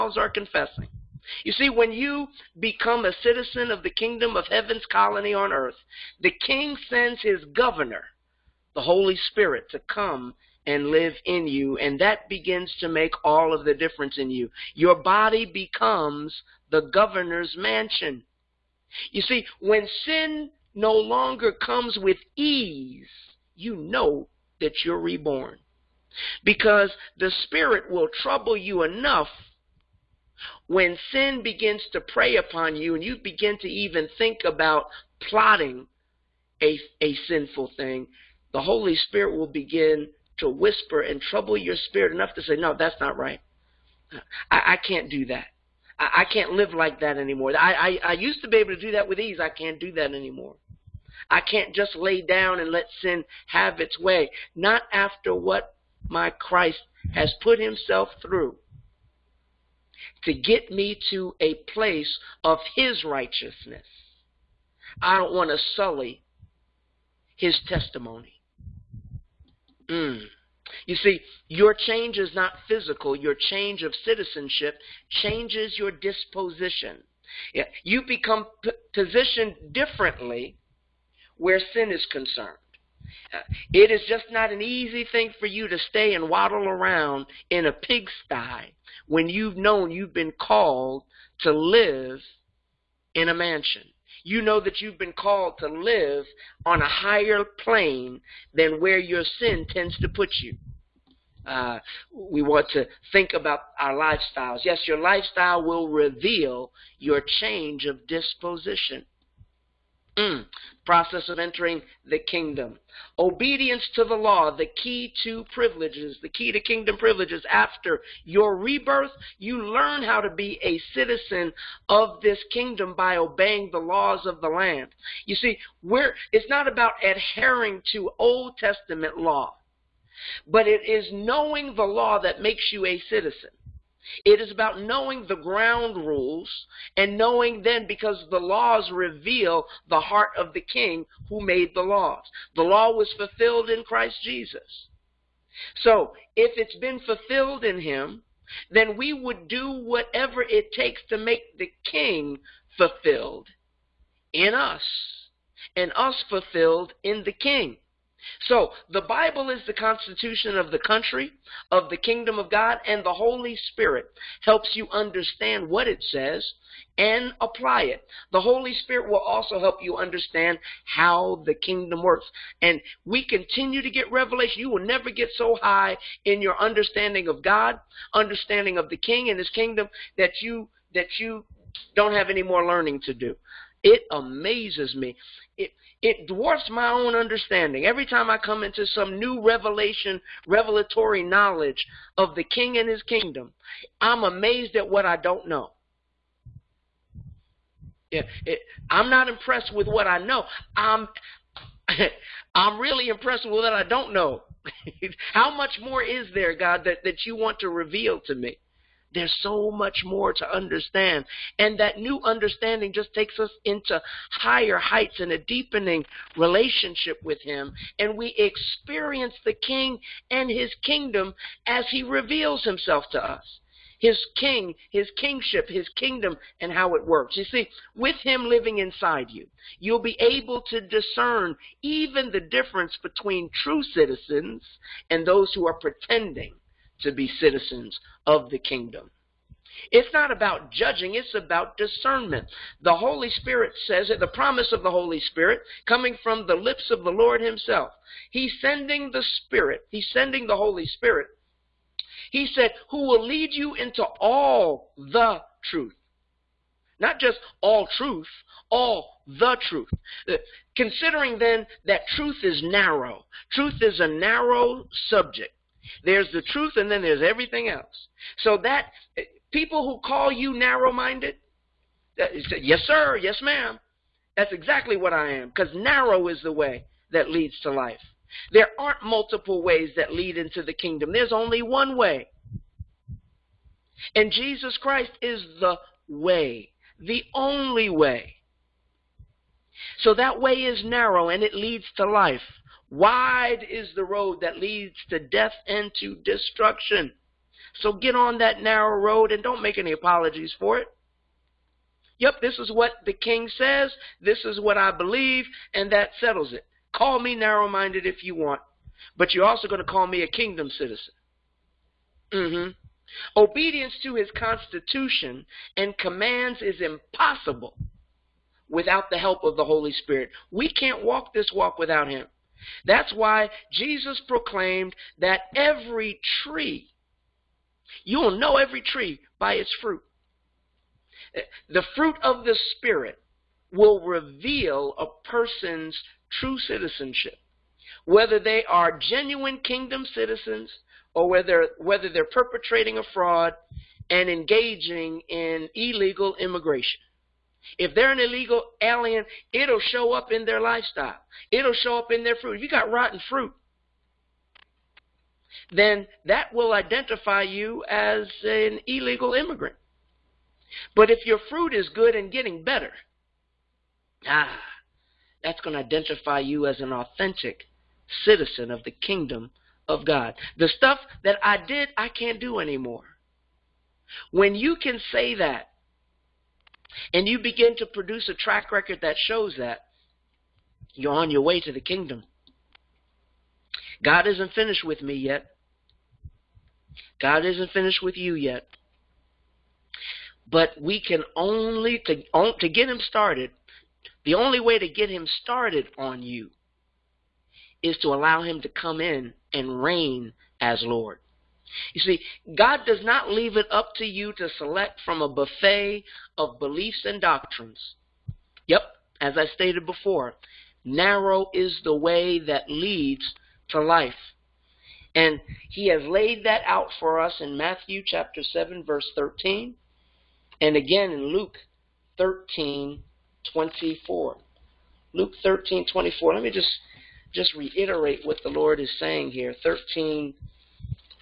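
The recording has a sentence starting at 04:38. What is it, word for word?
There aren't multiple ways that lead into the kingdom.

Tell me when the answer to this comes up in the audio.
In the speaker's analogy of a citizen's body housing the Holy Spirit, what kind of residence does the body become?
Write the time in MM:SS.
00:16.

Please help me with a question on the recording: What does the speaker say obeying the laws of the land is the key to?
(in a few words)
Kingdom privileges.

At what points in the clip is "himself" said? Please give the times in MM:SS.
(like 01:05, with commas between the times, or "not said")
00:57, 03:42, 04:07.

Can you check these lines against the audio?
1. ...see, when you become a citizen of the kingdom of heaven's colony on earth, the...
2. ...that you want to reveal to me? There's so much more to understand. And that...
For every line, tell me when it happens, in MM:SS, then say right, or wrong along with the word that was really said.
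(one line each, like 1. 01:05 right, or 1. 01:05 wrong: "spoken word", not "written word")
1. 00:01 right
2. 03:27 right.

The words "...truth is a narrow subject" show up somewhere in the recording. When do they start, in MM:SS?
04:23.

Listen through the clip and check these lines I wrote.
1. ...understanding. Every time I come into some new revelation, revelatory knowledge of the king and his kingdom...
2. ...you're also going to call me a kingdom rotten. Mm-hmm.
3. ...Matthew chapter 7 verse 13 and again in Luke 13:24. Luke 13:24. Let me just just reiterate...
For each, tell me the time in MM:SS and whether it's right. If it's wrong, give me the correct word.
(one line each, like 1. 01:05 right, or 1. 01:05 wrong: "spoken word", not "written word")
1. 03:07 right
2. 05:09 wrong: "citizen", not "rotten"
3. 06:57 right.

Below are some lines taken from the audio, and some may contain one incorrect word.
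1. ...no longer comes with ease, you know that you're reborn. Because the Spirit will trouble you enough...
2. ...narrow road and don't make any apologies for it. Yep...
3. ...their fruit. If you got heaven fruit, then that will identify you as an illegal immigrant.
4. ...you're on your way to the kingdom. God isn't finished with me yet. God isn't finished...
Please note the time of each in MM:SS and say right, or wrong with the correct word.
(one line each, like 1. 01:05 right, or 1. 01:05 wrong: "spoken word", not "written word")
1. 00:20 right
2. 04:58 right
3. 05:52 wrong: "rotten", not "heaven"
4. 06:20 right.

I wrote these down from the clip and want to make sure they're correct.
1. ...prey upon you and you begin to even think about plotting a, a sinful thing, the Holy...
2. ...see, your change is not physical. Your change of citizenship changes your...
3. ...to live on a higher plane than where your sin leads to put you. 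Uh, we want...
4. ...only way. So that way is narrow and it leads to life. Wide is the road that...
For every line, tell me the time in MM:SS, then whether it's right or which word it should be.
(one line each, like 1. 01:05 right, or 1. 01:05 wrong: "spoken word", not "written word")
1. 00:32 right
2. 01:10 right
3. 01:35 wrong: "tends", not "leads"
4. 04:47 right.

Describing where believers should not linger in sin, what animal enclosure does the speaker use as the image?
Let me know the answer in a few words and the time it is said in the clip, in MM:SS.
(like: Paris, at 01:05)
A pigsty, at 01:27.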